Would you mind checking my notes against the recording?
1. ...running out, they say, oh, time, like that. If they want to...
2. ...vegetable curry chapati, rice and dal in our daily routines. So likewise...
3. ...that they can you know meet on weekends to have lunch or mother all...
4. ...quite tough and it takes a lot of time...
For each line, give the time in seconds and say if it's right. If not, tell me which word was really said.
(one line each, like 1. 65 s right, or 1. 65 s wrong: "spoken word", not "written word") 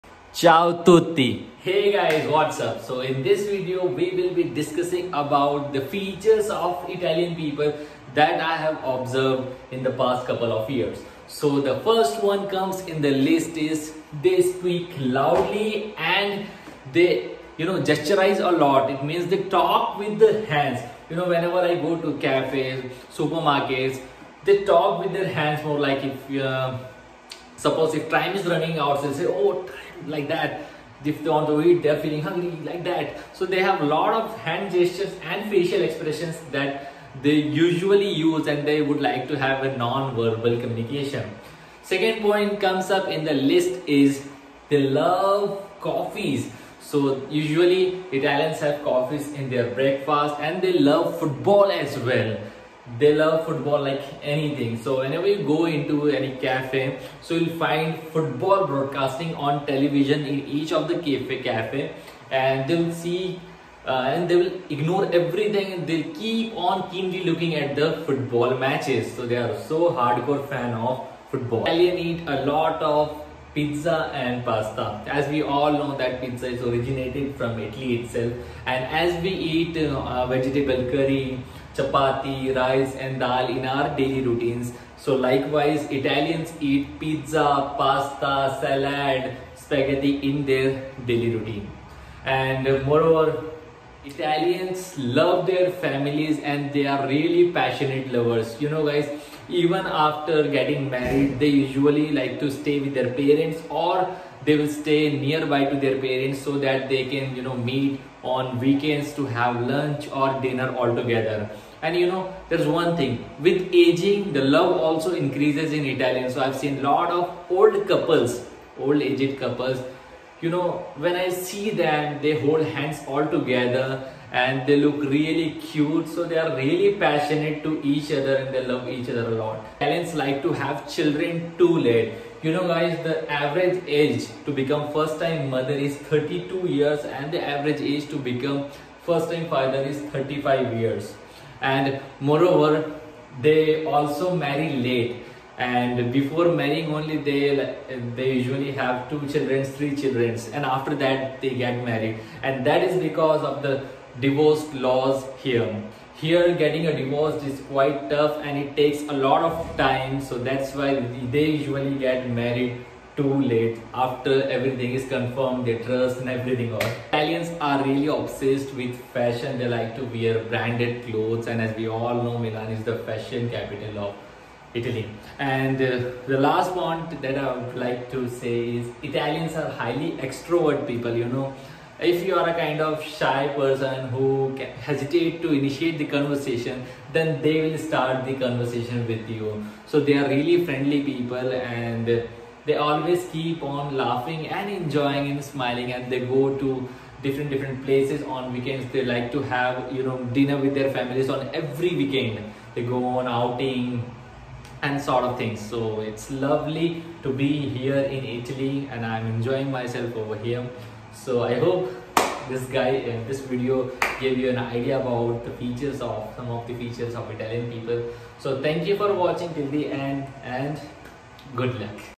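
1. 28 s right
2. 80 s right
3. 106 s wrong: "dinner", not "mother"
4. 157 s right.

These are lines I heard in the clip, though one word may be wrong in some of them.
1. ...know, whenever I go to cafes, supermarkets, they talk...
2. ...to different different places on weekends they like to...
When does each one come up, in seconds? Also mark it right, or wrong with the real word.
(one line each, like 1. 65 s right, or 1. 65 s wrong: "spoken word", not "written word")
1. 21 s right
2. 196 s right.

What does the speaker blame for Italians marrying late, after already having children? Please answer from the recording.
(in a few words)
divorce laws.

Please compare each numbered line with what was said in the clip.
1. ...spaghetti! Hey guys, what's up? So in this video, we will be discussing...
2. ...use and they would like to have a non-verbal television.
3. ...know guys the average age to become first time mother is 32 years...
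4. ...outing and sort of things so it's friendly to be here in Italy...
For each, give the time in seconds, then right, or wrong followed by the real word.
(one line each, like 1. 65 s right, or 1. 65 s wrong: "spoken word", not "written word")
1. 0 s wrong: "tutti", not "spaghetti"
2. 38 s wrong: "communication", not "television"
3. 132 s right
4. 203 s wrong: "lovely", not "friendly".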